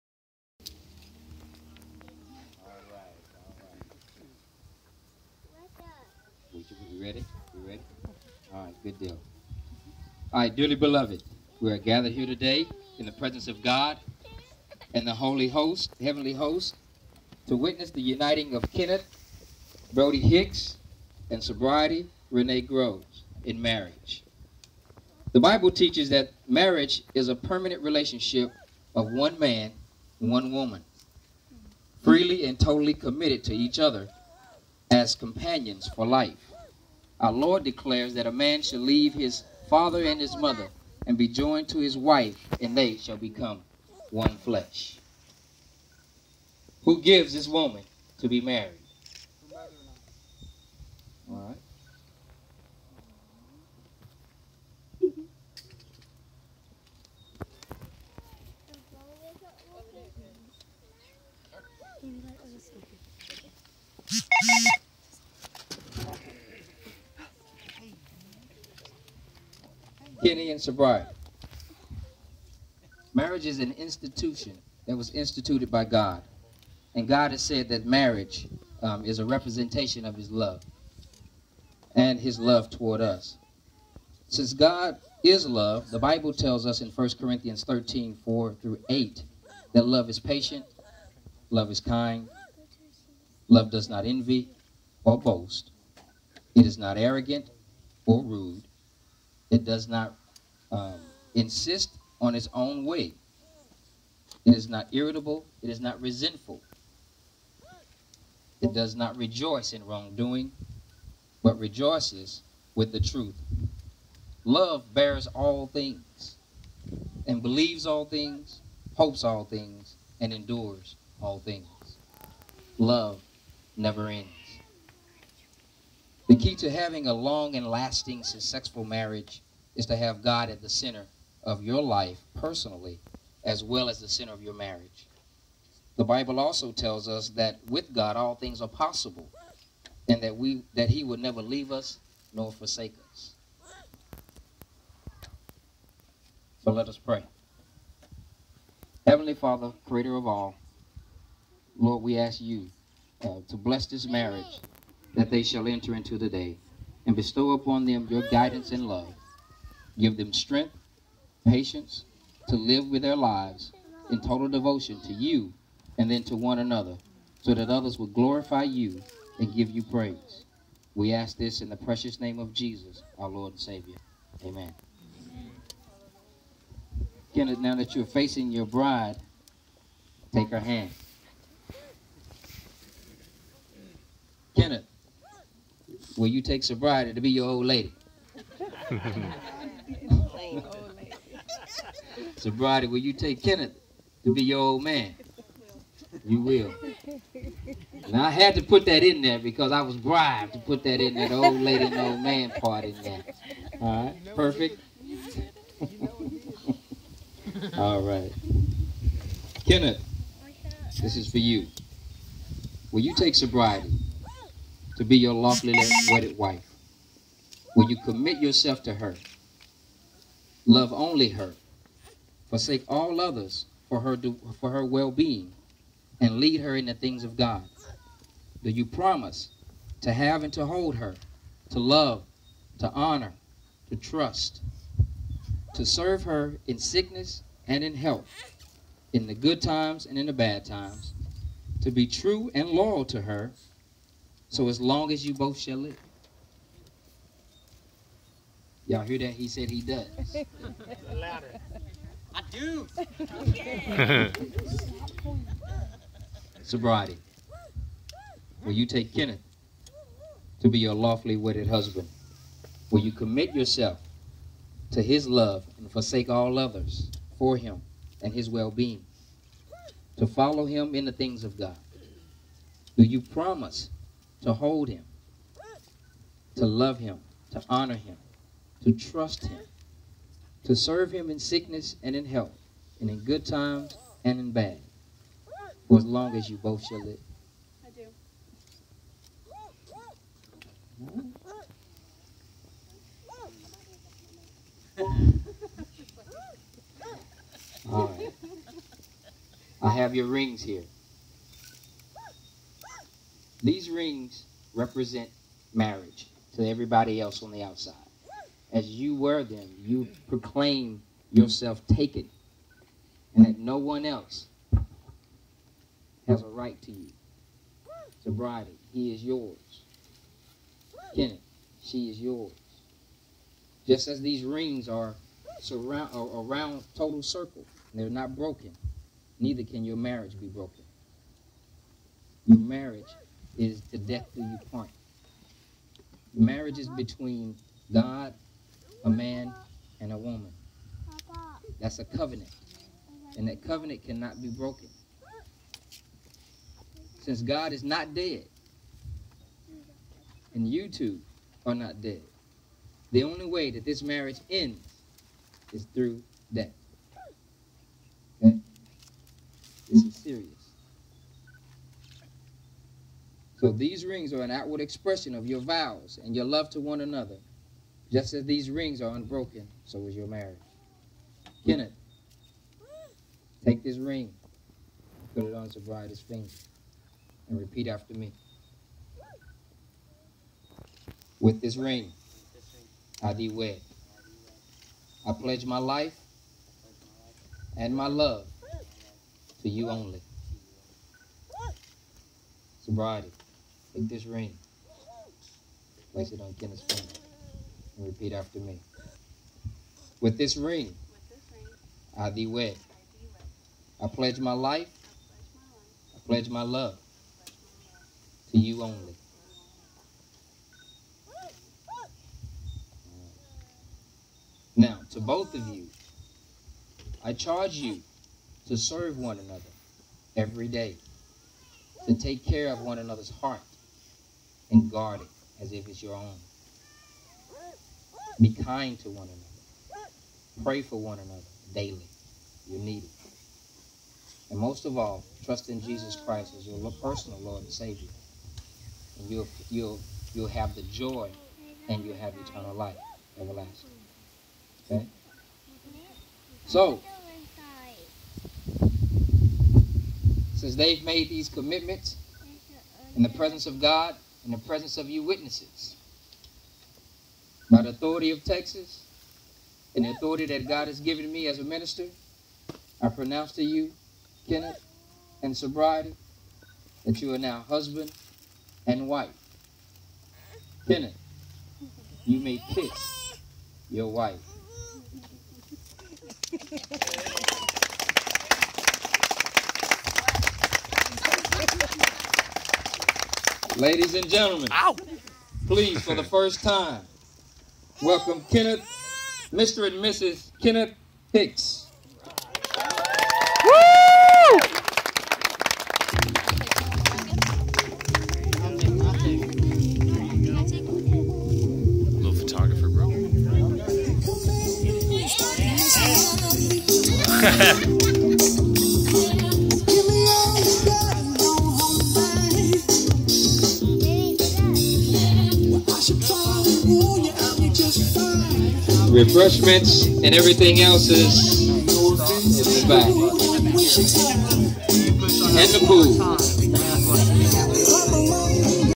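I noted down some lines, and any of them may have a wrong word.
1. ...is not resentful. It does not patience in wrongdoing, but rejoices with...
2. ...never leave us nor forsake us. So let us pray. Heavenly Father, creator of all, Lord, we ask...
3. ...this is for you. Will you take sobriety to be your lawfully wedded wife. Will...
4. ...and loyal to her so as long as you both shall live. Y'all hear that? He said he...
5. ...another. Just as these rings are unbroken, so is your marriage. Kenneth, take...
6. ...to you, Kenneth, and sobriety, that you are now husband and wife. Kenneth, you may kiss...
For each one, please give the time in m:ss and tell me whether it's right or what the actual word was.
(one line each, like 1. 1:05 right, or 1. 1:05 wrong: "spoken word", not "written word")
1. 1:45 wrong: "rejoice", not "patience"
2. 2:21 right
3. 3:31 right
4. 4:02 right
5. 6:07 right
6. 7:43 right.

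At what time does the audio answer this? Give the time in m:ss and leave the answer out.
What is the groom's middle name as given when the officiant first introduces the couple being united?
0:19.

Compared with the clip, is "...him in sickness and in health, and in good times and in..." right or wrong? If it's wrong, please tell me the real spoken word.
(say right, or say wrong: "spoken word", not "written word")
right.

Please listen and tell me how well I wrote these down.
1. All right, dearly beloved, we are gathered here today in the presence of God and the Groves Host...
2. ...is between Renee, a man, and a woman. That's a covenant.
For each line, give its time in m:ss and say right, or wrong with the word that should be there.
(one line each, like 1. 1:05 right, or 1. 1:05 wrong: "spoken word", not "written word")
1. 0:10 wrong: "Holy", not "Groves"
2. 5:36 wrong: "God", not "Renee".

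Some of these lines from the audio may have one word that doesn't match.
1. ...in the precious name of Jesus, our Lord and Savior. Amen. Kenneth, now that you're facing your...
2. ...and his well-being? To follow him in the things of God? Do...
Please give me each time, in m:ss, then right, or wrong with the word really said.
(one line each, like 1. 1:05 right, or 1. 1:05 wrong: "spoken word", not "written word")
1. 2:51 right
2. 4:28 right.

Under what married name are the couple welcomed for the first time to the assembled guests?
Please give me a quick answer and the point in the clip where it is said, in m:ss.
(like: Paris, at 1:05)
Mr. and Mrs. Kenneth Hicks, at 8:09.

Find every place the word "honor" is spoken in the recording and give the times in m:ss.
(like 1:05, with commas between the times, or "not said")
3:52, 4:37.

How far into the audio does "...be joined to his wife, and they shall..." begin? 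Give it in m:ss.
0:41.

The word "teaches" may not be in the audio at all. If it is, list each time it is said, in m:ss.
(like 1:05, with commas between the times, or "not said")
0:25.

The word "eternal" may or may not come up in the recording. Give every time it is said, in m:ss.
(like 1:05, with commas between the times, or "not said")
7:22.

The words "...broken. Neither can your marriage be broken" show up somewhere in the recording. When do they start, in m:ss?
5:28.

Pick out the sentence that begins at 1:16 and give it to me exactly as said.
And God has said that marriage um, is a representation of his love and his love toward us.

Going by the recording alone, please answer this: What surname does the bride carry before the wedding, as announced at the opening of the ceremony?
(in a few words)
Groves.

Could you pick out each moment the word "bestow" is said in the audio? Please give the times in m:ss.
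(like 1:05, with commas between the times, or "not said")
2:37.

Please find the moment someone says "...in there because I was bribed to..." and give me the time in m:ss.
3:19.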